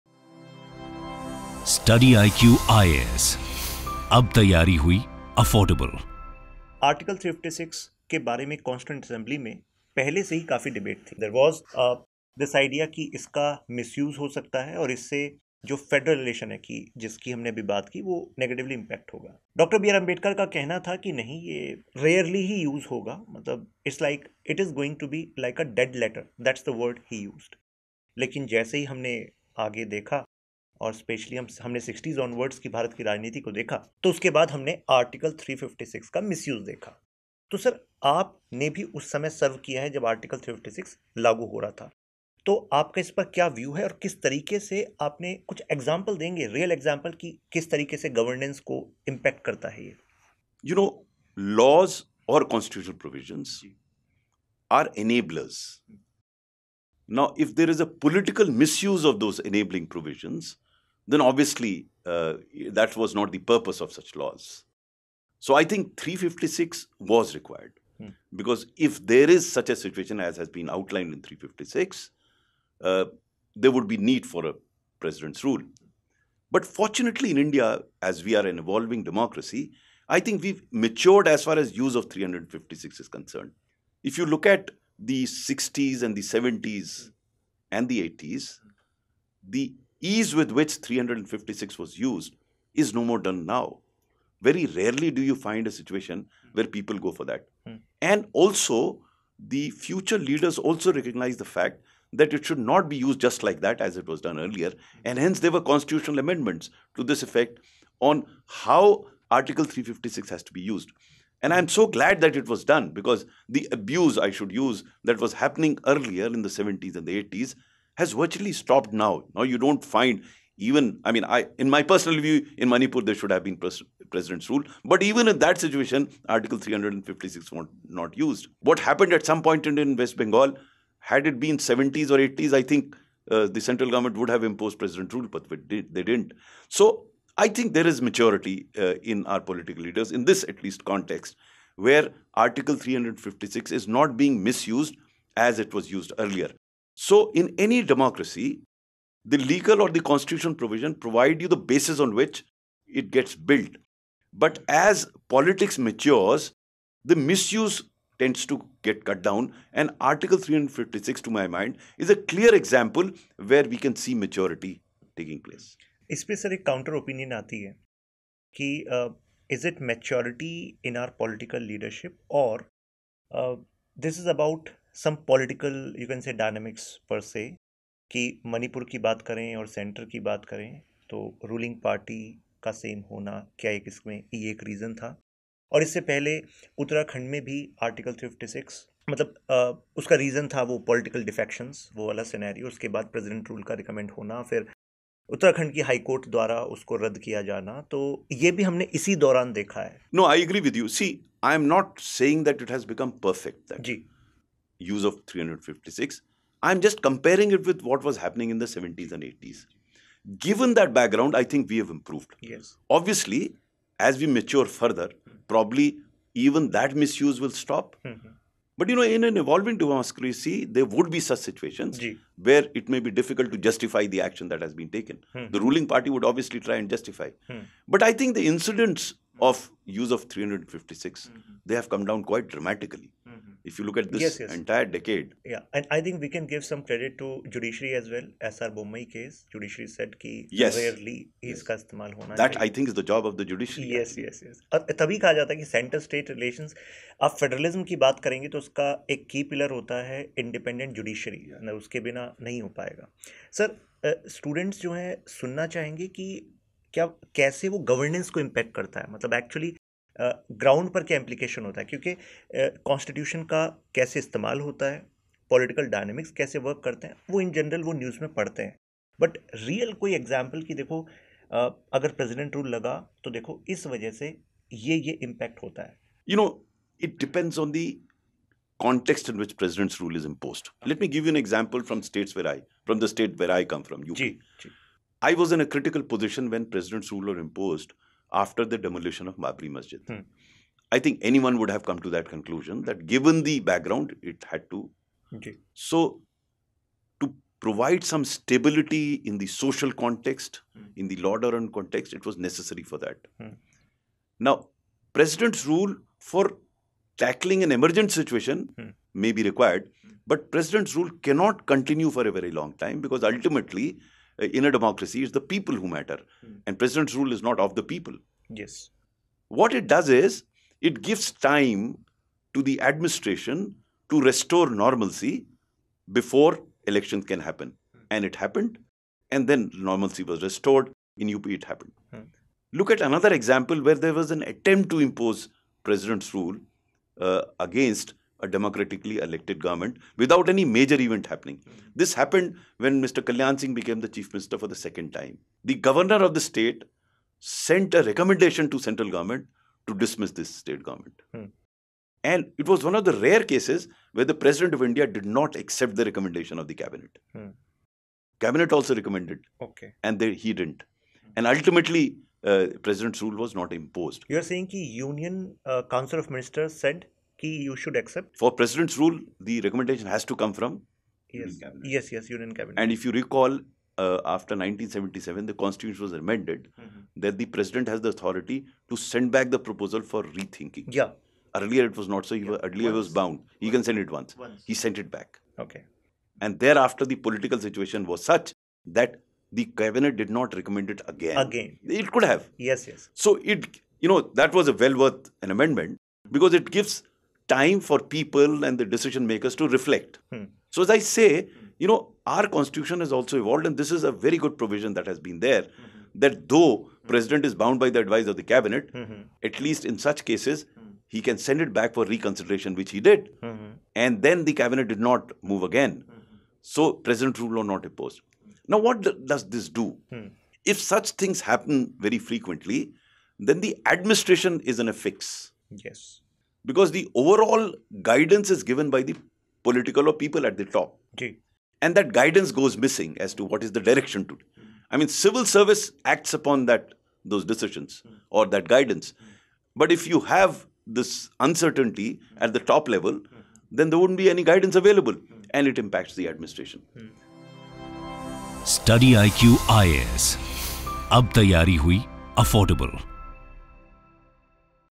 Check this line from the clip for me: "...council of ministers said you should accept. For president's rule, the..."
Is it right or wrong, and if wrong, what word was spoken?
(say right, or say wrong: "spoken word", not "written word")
right.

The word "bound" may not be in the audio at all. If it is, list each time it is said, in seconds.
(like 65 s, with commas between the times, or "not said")
383 s, 407 s.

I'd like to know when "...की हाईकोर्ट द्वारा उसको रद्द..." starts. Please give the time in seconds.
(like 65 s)
195 s.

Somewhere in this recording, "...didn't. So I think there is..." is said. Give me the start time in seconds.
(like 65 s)
136 s.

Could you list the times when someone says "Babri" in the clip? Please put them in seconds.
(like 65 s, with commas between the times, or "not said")
289 s.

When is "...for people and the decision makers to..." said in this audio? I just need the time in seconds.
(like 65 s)
397 s.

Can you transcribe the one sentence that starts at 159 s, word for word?
And Article 356, to my mind, is a clear example where we can see maturity taking place.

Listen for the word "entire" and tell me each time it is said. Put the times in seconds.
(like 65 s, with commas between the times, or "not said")
234 s.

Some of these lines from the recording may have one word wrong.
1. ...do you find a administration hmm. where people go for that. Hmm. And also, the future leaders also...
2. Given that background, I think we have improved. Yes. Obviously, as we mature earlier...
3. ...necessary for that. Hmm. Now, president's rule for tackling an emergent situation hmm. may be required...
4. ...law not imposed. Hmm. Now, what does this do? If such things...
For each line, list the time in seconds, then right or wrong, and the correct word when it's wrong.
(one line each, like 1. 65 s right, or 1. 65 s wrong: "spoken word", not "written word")
1. 95 s wrong: "situation", not "administration"
2. 210 s wrong: "further", not "earlier"
3. 302 s right
4. 417 s right.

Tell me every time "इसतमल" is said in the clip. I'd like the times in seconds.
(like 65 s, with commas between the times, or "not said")
241 s, 264 s.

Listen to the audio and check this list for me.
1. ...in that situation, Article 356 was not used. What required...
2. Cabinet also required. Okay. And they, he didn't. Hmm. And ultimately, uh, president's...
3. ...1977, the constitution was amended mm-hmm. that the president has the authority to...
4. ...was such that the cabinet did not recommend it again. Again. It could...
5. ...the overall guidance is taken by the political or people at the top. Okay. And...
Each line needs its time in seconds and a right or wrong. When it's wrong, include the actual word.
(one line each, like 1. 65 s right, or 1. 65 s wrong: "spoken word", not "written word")
1. 125 s wrong: "happened", not "required"
2. 358 s wrong: "recommended", not "required"
3. 374 s right
4. 388 s right
5. 426 s wrong: "given", not "taken".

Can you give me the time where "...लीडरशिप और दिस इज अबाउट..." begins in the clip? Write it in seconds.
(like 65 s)
171 s.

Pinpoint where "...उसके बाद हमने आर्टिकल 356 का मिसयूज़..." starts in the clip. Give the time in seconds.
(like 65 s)
34 s.